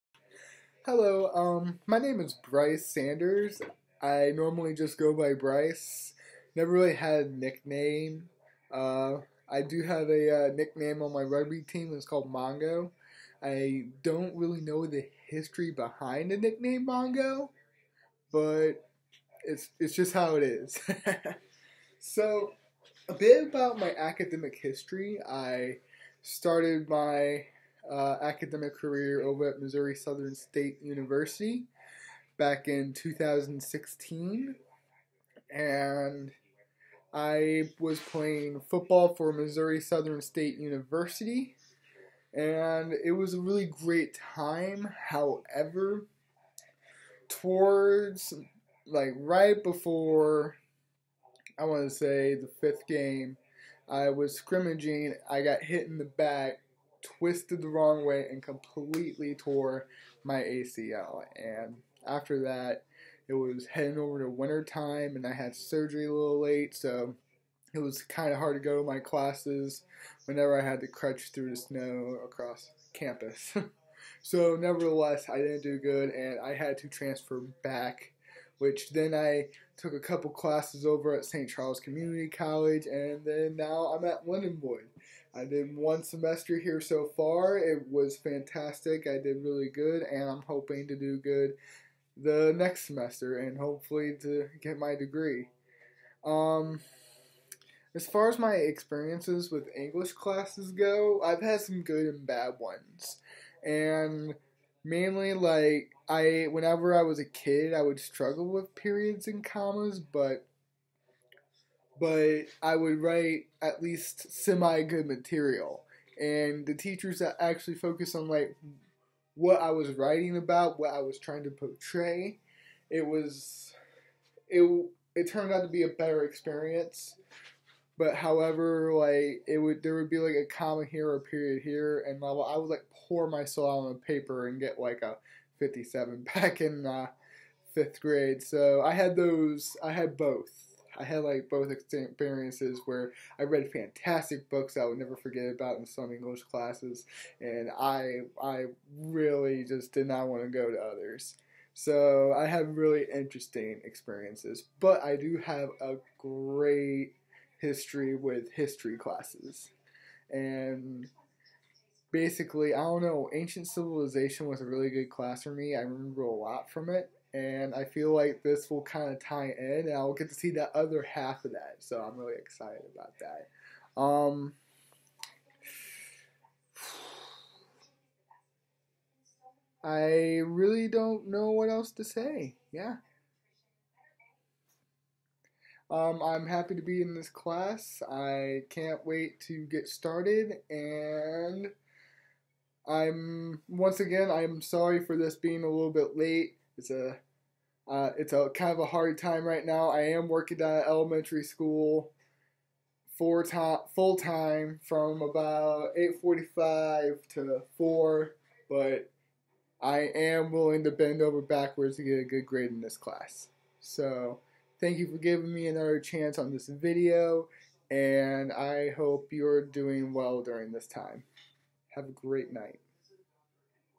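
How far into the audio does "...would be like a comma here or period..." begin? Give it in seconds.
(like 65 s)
129 s.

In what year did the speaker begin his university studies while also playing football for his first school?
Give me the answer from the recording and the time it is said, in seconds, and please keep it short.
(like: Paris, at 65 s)
2016, at 32 s.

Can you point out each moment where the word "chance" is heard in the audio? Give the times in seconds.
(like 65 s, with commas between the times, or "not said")
215 s.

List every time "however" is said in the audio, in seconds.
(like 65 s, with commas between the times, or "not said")
45 s, 128 s.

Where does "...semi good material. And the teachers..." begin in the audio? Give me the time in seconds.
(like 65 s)
114 s.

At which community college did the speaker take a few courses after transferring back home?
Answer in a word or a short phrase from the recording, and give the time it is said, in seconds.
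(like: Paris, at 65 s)
St. Charles Community College, at 81 s.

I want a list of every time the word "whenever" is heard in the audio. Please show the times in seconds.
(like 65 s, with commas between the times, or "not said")
70 s, 106 s.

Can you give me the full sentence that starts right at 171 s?
So I'm really excited about that.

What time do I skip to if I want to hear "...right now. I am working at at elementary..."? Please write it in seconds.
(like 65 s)
199 s.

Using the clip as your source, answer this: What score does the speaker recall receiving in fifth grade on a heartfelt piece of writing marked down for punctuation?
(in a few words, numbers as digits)
57.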